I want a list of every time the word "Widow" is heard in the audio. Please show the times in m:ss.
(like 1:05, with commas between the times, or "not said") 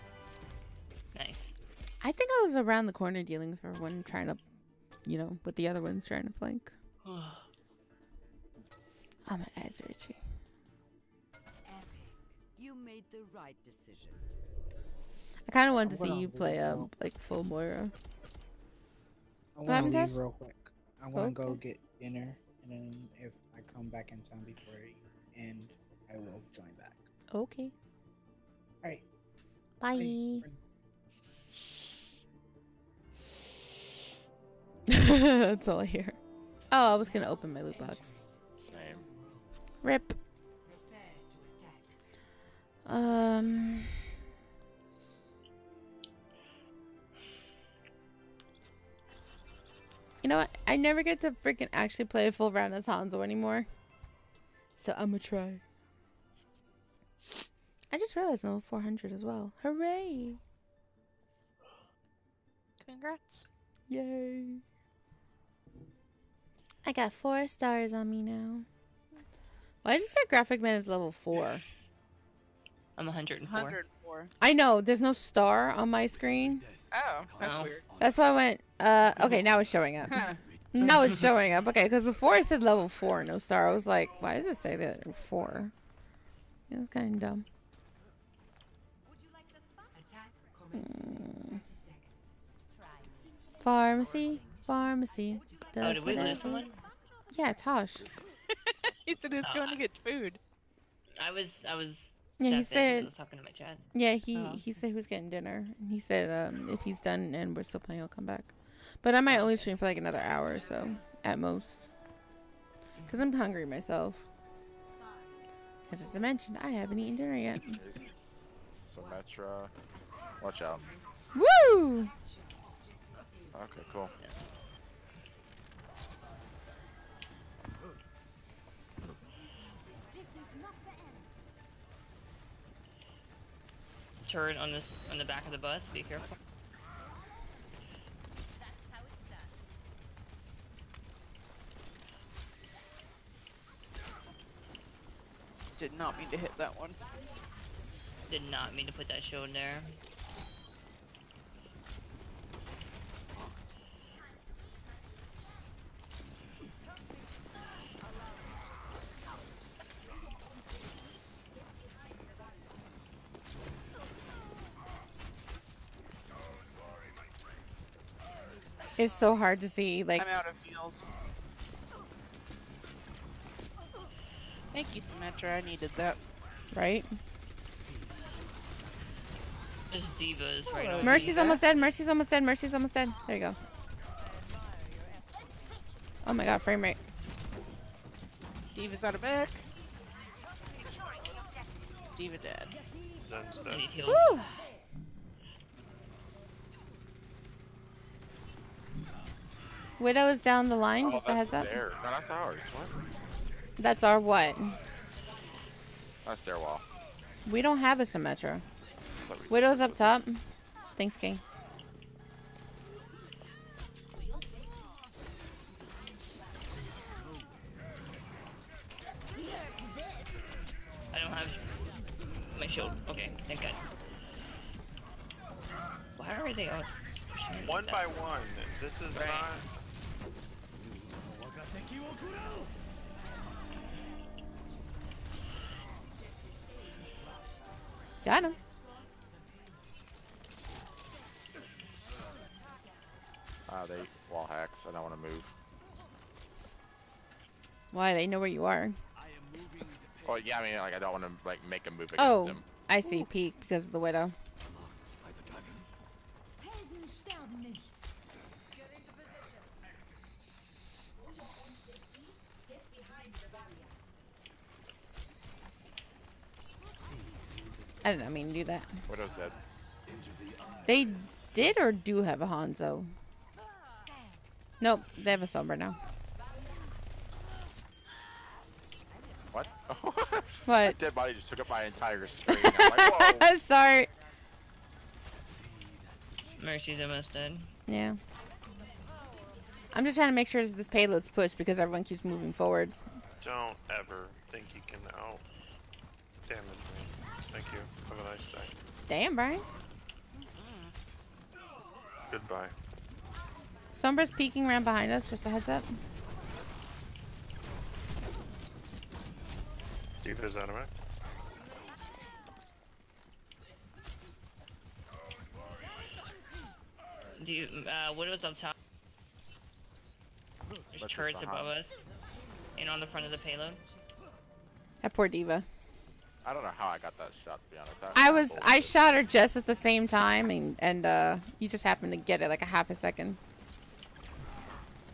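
3:19, 3:29, 4:13, 5:18.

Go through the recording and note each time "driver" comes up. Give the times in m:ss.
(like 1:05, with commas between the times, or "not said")
not said.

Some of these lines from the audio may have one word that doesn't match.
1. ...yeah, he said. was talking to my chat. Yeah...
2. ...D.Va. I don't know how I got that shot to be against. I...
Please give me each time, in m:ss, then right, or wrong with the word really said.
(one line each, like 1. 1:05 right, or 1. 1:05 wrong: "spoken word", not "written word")
1. 1:42 right
2. 5:25 wrong: "honest", not "against".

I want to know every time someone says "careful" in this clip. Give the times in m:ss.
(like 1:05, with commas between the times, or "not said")
2:16.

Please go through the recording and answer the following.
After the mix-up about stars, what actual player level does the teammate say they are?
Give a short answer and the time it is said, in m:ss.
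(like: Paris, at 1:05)
104, at 1:12.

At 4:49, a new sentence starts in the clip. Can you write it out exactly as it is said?
I'm just trying to make sure this payload's pushed because everyone keeps moving forward.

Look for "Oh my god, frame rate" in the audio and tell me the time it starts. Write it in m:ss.
3:06.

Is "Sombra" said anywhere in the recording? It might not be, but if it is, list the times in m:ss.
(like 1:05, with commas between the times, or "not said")
4:35, 5:03.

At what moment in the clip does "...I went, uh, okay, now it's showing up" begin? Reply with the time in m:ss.
1:18.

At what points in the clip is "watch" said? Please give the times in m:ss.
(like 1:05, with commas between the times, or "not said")
2:00.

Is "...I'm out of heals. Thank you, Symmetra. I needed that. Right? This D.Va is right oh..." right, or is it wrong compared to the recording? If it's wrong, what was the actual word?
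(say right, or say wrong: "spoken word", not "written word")
right.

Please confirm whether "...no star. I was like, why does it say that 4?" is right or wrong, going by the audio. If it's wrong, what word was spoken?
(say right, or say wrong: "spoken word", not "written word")
right.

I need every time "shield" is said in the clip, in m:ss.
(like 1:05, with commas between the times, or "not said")
2:29, 3:42.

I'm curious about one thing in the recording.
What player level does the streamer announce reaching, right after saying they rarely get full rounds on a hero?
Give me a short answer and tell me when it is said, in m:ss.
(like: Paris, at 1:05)
400, at 0:58.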